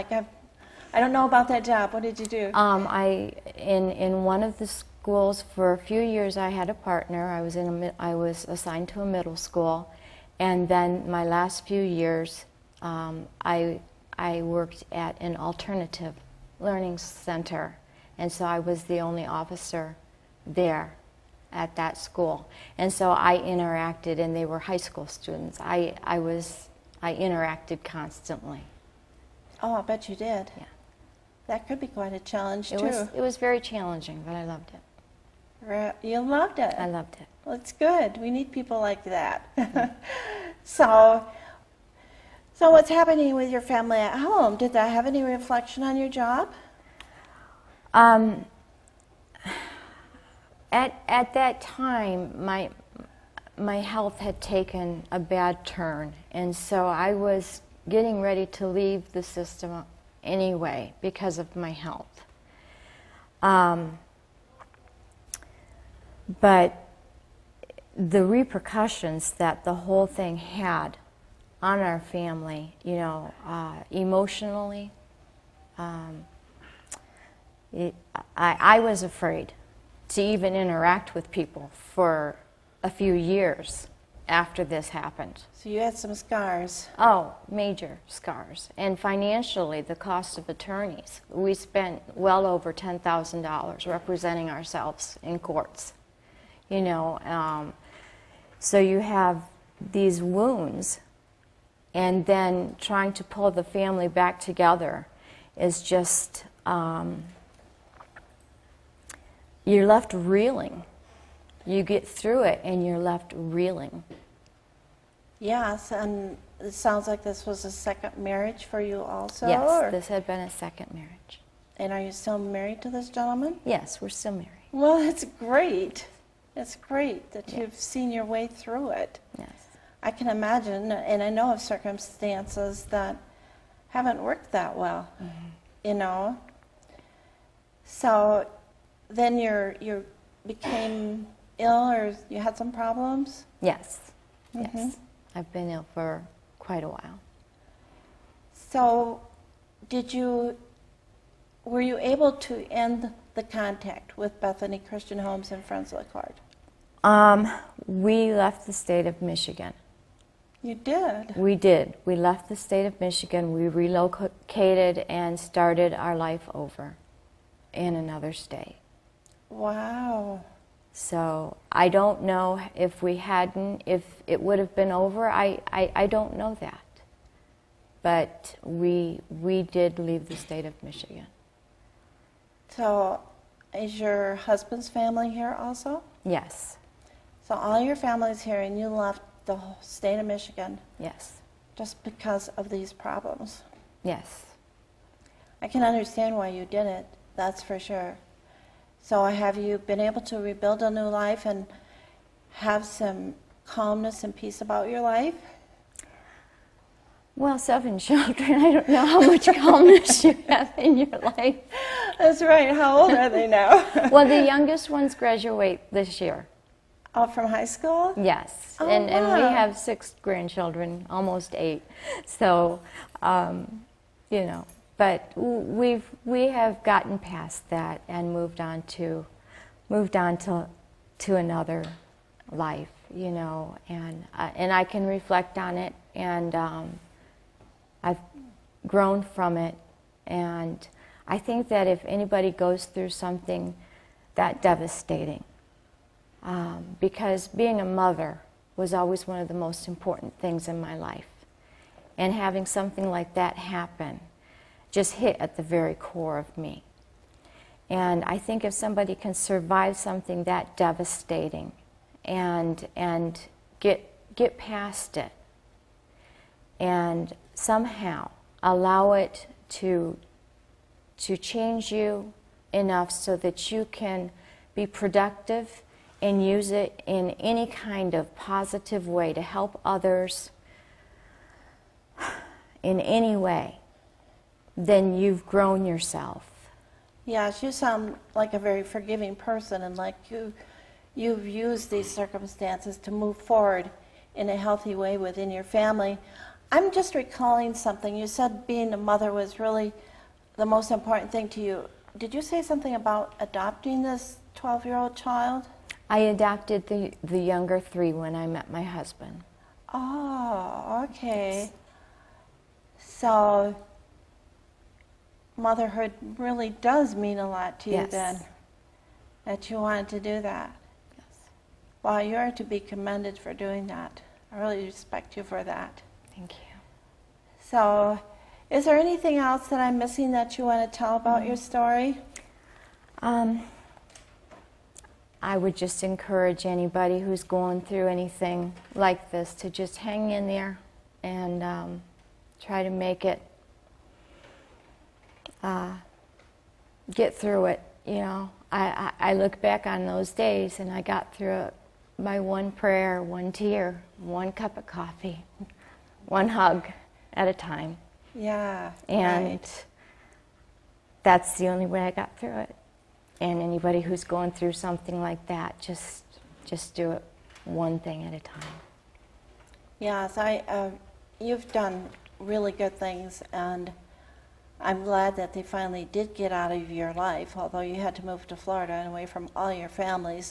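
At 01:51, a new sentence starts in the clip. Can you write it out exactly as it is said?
You get through it and you're left reeling.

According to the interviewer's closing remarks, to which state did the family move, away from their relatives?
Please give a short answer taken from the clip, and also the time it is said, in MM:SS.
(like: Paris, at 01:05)
Florida, at 06:18.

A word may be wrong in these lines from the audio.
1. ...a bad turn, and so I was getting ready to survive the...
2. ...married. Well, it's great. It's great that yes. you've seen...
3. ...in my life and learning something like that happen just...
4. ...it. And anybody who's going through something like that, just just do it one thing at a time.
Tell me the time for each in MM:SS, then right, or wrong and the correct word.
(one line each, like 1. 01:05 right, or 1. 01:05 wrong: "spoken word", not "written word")
1. 00:55 wrong: "leave", not "survive"
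2. 02:04 right
3. 04:10 wrong: "having", not "learning"
4. 06:02 right.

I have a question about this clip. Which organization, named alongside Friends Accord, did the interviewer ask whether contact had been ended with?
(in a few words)
Bethany Christian Homes.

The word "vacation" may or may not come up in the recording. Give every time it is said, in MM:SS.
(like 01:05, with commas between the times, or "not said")
not said.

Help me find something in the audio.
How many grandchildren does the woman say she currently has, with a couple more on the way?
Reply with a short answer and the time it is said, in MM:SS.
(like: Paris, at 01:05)
6, at 03:39.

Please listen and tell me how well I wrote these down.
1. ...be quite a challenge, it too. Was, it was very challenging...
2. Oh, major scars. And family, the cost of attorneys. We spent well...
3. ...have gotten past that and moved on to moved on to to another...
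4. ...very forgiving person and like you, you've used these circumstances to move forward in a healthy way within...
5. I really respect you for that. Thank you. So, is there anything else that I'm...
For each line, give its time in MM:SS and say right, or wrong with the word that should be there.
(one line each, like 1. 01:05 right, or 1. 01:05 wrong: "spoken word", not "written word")
1. 00:31 right
2. 01:26 wrong: "financially", not "family"
3. 03:46 right
4. 04:48 right
5. 05:24 right.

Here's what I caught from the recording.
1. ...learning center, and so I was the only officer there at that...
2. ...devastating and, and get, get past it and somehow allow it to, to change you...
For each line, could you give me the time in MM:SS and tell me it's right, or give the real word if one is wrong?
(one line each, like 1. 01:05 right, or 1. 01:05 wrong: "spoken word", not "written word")
1. 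00:16 right
2. 04:20 right.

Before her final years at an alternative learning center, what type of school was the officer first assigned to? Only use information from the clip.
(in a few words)
middle school.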